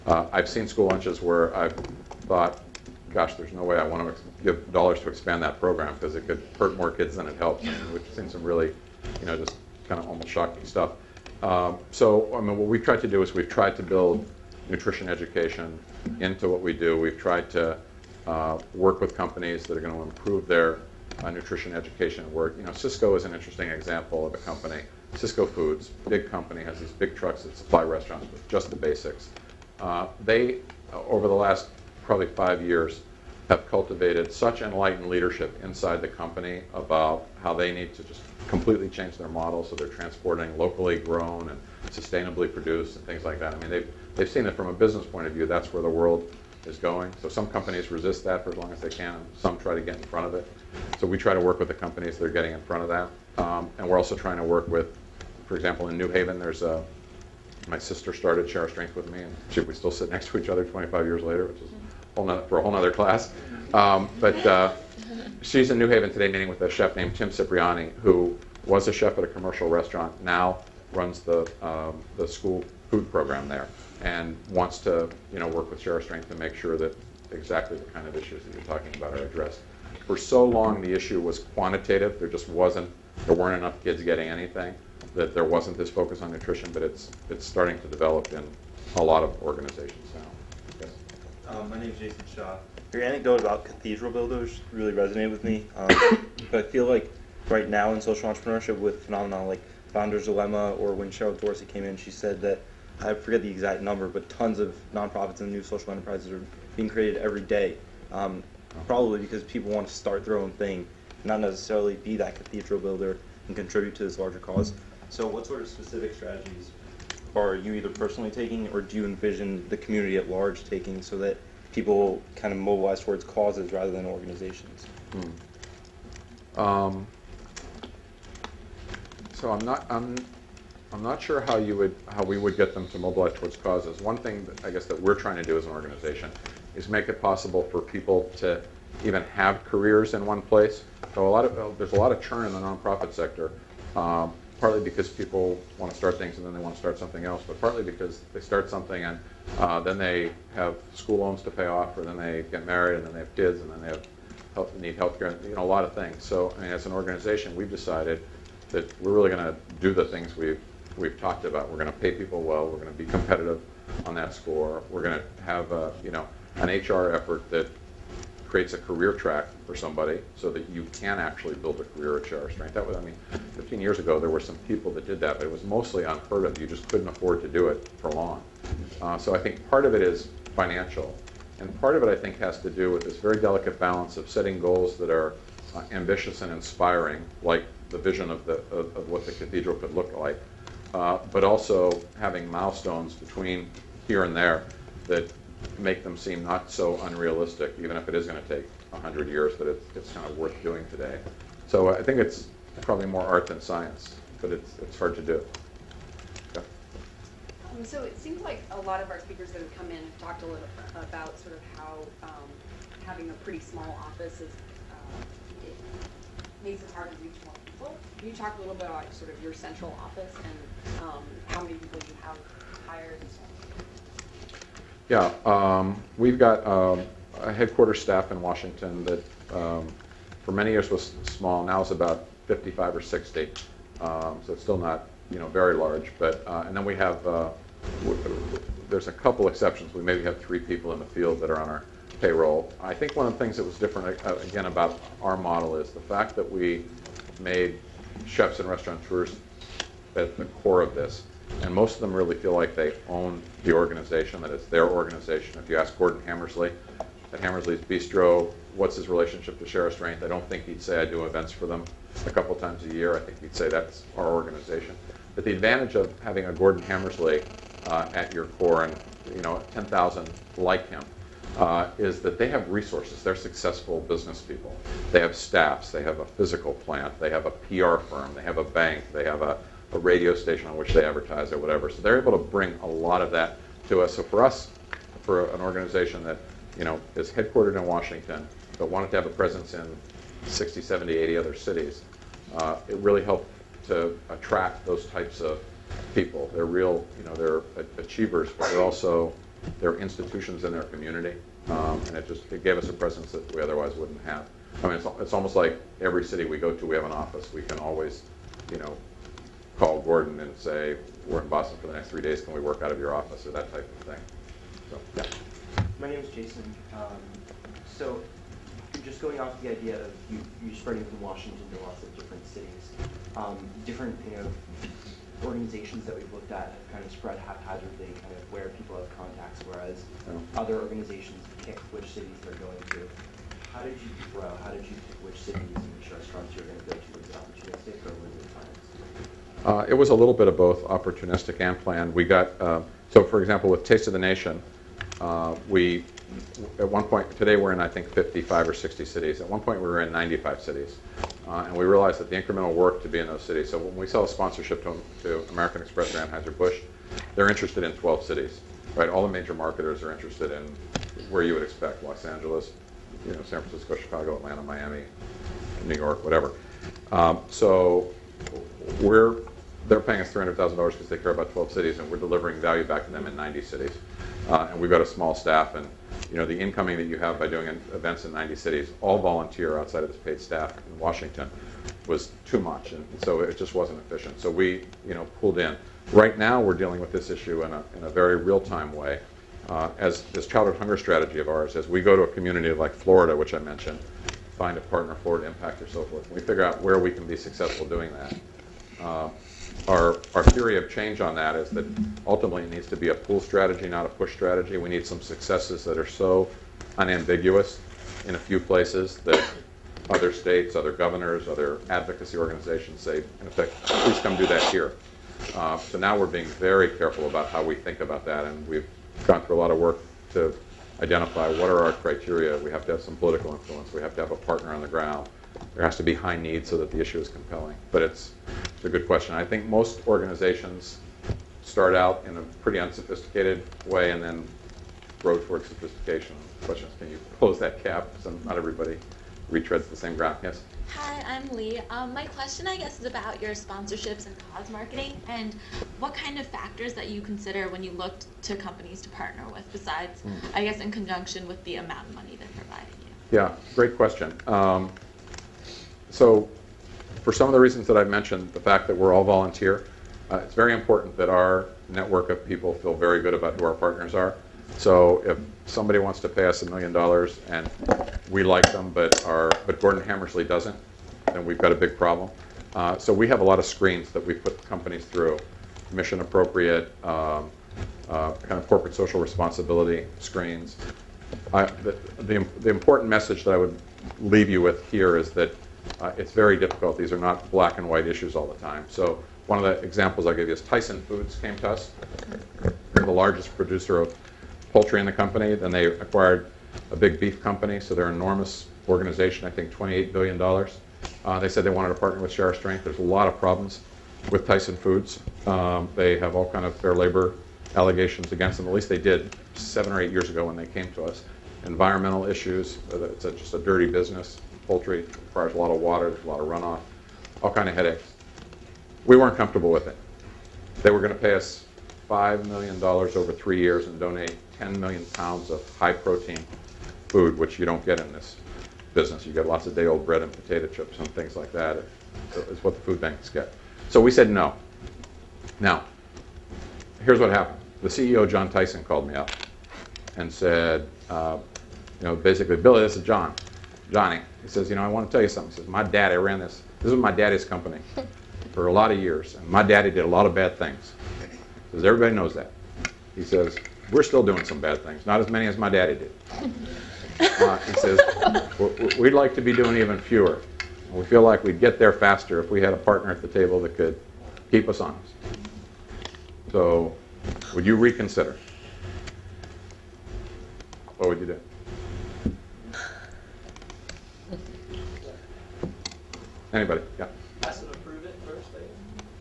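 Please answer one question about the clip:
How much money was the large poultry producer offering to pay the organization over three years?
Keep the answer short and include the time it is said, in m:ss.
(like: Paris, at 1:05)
$5 million, at 8:42.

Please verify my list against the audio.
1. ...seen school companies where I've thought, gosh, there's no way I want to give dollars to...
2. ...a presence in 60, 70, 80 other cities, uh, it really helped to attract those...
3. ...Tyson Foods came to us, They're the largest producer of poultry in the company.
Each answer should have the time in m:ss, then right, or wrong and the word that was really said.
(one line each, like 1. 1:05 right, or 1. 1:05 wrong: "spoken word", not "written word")
1. 0:00 wrong: "lunches", not "companies"
2. 4:49 right
3. 8:10 right.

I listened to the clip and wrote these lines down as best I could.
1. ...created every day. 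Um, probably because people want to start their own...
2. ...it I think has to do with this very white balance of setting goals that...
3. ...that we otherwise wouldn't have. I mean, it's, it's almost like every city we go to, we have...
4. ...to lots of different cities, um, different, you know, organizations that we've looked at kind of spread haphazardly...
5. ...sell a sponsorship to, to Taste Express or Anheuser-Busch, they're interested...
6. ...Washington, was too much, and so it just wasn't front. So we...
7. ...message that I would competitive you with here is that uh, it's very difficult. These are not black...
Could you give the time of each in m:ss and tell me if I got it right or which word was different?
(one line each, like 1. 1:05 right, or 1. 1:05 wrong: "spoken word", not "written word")
1. 1:46 right
2. 3:02 wrong: "delicate", not "white"
3. 5:03 right
4. 5:21 right
5. 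5:54 wrong: "American", not "Taste"
6. 6:20 wrong: "efficient", not "front"
7. 8:03 wrong: "leave", not "competitive".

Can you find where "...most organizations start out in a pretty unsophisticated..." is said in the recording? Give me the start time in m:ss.
7:09.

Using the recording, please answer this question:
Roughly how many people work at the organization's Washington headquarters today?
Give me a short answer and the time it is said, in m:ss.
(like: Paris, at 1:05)
55 or 60, at 3:51.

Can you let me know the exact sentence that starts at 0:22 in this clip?
You know, Sysco is an interesting example of a company.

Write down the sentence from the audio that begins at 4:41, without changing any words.
So they're able to bring a lot of that to us.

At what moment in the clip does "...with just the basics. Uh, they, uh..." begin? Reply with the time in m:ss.
0:28.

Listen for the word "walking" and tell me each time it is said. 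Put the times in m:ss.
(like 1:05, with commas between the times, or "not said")
not said.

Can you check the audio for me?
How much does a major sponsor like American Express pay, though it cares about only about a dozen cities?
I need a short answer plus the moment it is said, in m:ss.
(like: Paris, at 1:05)
$300,000, at 6:10.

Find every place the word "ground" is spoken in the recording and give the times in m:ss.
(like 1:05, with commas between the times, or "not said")
7:04, 7:20.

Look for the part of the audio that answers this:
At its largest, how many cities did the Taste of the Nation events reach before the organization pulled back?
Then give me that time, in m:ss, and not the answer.
5:50.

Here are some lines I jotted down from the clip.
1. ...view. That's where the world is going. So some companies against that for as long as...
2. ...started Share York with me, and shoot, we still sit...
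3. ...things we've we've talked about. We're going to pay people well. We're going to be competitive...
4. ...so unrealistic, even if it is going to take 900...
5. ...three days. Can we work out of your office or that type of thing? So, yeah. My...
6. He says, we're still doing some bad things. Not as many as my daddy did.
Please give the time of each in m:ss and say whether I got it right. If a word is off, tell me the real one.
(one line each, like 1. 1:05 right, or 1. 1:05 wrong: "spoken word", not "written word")
1. 0:45 wrong: "resist", not "against"
2. 0:58 wrong: "Strength", not "York"
3. 2:40 right
4. 3:16 wrong: "100", not "900"
5. 5:12 right
6. 9:13 right.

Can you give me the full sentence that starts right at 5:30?
other organizations pick which cities they're going to.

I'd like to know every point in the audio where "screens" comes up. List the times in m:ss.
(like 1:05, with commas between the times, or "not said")
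7:53, 8:00.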